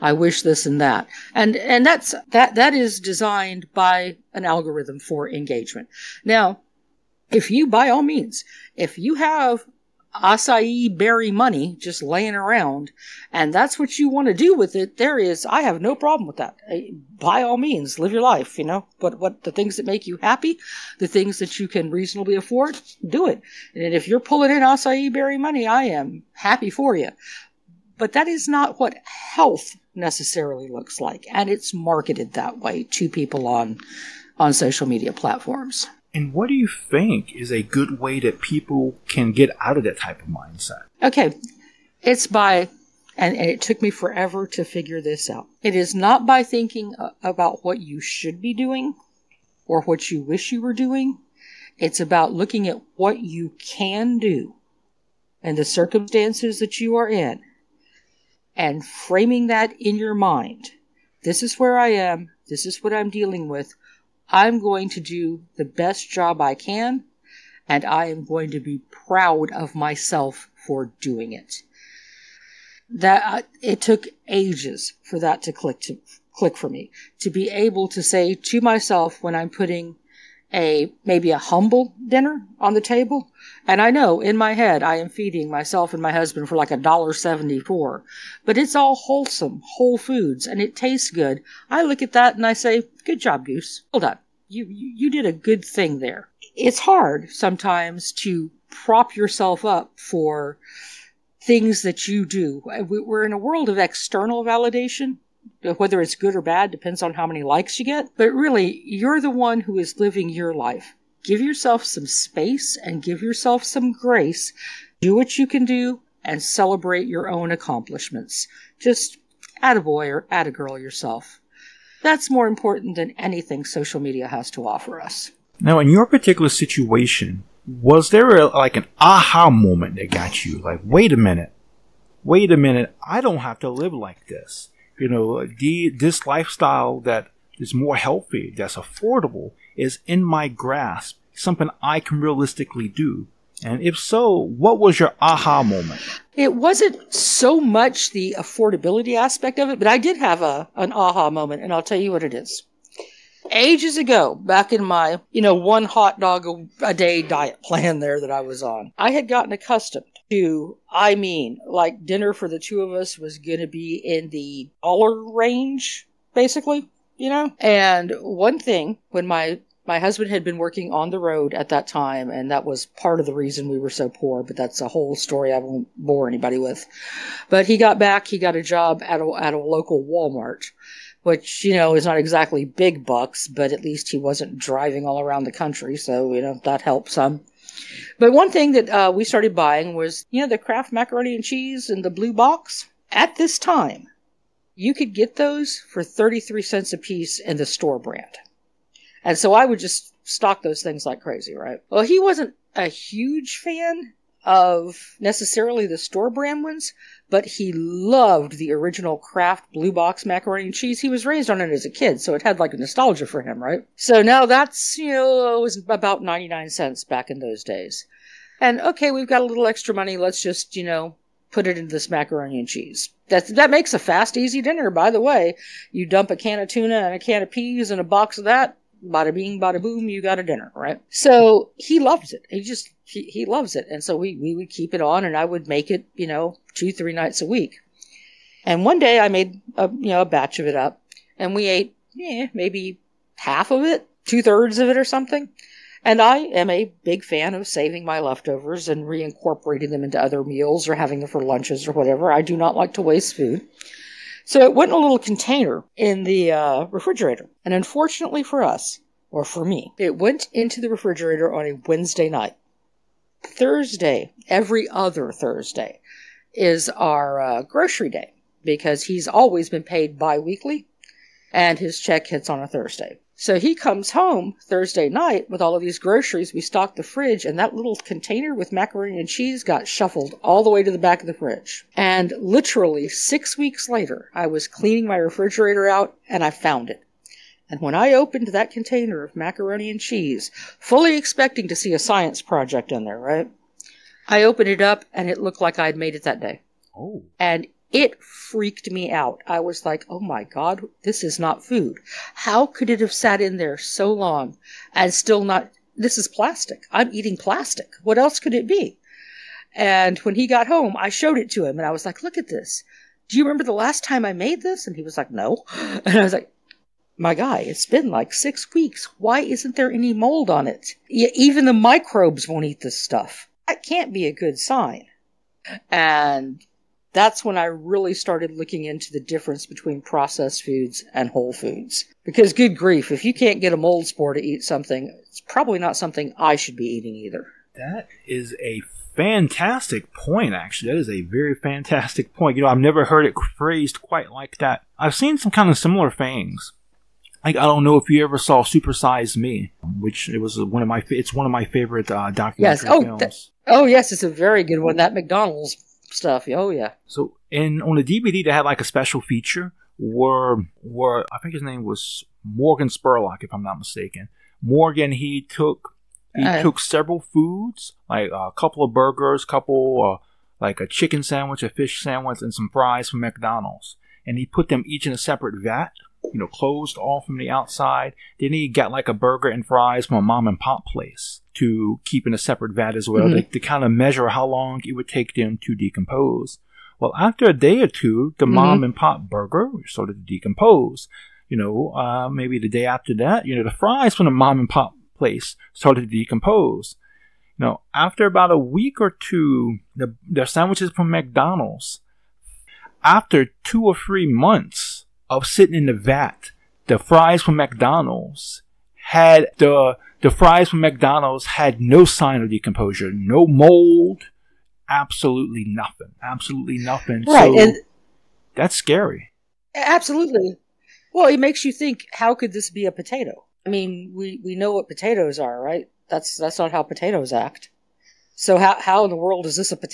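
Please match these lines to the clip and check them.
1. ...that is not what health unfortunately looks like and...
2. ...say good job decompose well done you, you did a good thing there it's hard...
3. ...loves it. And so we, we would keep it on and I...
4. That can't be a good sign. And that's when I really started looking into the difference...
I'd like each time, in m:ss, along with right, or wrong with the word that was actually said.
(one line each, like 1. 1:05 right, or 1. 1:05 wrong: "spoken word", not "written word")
1. 0:28 wrong: "necessarily", not "unfortunately"
2. 1:32 wrong: "goose", not "decompose"
3. 3:53 right
4. 5:23 right.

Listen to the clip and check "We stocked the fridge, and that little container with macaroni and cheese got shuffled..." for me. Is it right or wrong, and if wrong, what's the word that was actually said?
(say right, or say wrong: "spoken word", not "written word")
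right.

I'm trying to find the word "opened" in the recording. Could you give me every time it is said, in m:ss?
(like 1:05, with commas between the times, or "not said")
4:48, 4:54.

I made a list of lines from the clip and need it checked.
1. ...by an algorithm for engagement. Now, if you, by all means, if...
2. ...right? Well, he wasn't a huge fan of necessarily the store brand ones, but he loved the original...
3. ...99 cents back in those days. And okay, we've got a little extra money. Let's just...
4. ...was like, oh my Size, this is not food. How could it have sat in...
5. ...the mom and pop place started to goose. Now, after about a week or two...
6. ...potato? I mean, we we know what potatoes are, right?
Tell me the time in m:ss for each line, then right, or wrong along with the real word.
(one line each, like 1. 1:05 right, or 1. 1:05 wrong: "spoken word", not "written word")
1. 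0:03 right
2. 3:21 right
3. 3:36 right
4. 4:59 wrong: "God", not "Size"
5. 6:34 wrong: "decompose", not "goose"
6. 7:02 right.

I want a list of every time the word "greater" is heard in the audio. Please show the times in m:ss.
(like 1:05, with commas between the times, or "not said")
not said.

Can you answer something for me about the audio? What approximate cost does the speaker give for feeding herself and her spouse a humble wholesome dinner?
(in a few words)
$1.74.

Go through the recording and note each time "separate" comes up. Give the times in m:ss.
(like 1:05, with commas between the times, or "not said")
6:15, 6:22.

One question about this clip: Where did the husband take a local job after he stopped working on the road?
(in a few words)
Walmart.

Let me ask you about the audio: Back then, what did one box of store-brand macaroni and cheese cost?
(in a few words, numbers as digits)
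33 cents.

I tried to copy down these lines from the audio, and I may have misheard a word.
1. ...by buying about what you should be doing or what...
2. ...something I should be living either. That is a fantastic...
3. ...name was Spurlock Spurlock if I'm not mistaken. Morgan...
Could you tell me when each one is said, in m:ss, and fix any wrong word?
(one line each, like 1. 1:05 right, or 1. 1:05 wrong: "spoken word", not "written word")
1. 0:46 wrong: "thinking", not "buying"
2. 5:35 wrong: "eating", not "living"
3. 6:01 wrong: "Morgan", not "Spurlock".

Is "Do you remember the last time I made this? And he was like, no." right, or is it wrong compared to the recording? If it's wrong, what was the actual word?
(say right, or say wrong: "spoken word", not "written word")
right.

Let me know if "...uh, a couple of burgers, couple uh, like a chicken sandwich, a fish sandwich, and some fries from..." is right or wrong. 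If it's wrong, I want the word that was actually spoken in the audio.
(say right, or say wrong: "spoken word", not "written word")
right.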